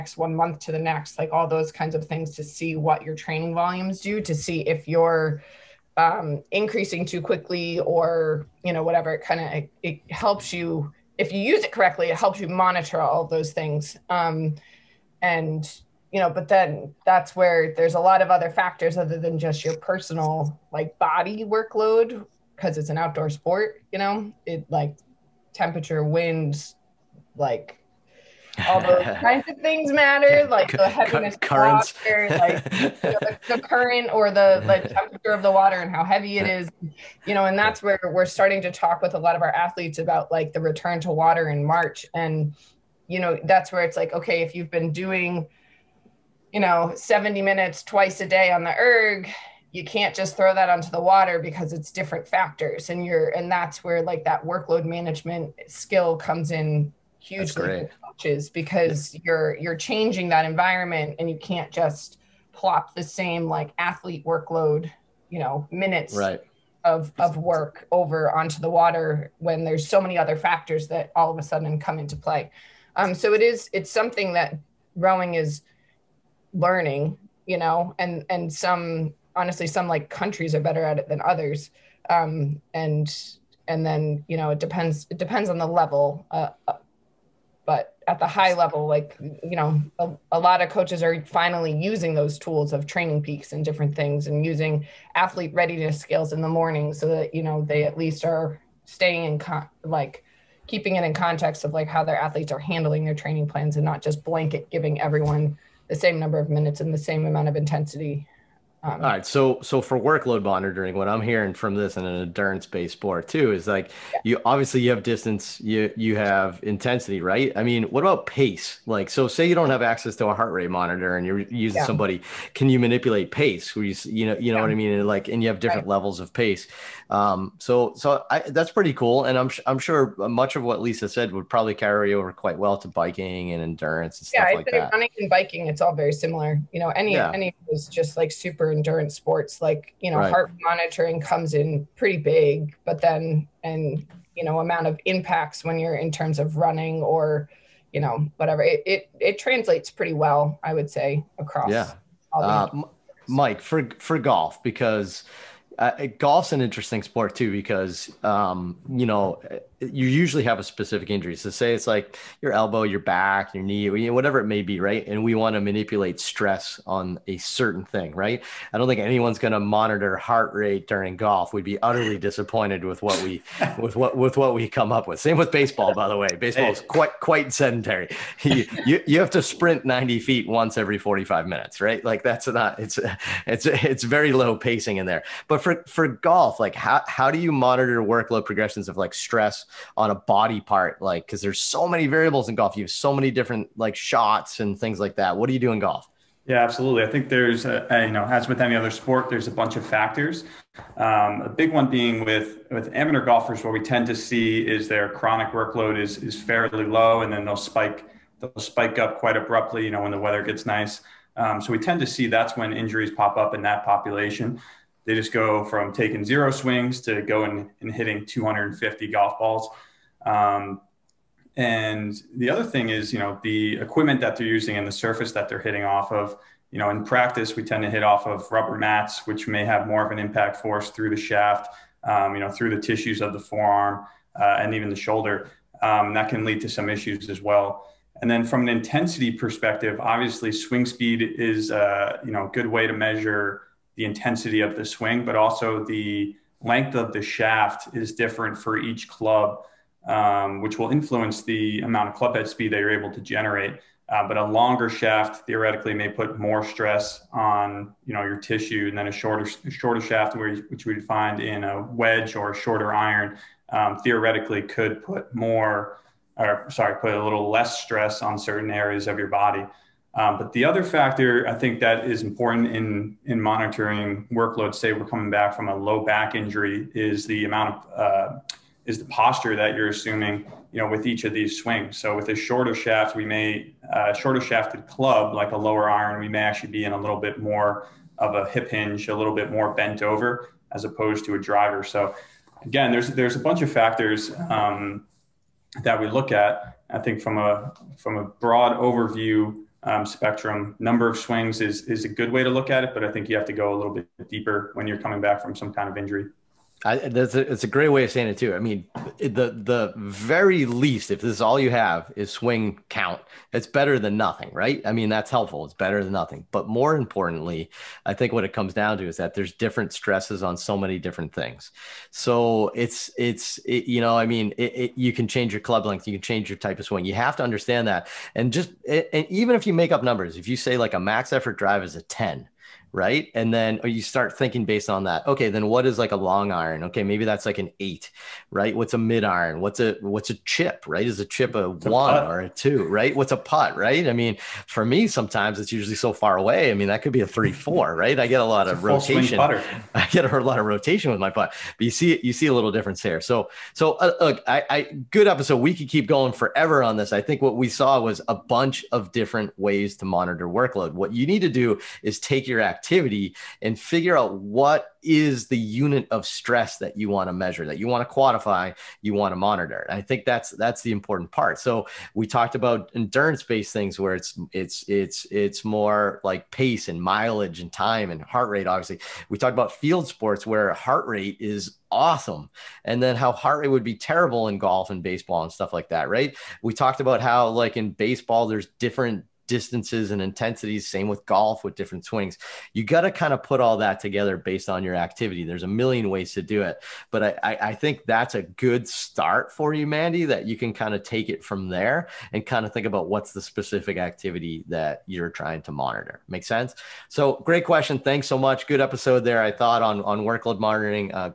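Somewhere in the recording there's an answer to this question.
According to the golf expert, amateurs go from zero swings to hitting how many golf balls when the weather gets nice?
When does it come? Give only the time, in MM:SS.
03:38.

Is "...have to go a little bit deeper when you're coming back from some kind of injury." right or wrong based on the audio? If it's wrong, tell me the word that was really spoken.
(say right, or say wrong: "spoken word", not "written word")
right.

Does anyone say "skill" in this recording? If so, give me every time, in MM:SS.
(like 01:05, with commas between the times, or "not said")
00:55.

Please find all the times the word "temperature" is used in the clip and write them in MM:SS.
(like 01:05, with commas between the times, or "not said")
00:25, 00:34.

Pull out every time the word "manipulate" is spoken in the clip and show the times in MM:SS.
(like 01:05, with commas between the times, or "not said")
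02:02, 02:45.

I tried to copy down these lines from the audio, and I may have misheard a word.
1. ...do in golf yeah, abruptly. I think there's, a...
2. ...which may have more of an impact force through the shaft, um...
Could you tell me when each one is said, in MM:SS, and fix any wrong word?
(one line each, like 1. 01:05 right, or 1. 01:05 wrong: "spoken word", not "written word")
1. 03:15 wrong: "absolutely", not "abruptly"
2. 03:49 right.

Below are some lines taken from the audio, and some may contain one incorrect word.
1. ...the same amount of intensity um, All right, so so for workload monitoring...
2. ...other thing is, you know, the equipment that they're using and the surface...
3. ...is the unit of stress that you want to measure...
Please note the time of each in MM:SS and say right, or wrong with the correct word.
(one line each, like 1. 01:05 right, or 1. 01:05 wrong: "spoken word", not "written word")
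1. 01:46 right
2. 03:42 right
3. 06:05 right.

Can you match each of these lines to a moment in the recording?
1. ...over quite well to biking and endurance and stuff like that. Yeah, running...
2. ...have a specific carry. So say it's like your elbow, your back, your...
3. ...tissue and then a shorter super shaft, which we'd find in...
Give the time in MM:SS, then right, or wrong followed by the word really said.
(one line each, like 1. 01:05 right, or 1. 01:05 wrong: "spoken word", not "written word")
1. 02:12 right
2. 02:40 wrong: "injury", not "carry"
3. 04:18 wrong: "shorter", not "super".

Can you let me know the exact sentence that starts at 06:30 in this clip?
Same with golf with different swings.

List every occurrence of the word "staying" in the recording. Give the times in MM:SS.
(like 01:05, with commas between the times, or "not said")
01:38.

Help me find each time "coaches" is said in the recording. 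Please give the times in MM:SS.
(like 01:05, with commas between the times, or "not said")
00:58, 01:30.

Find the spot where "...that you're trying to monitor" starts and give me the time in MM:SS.
06:44.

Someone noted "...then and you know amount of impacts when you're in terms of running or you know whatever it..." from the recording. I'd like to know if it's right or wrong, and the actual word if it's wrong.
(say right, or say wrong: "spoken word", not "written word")
right.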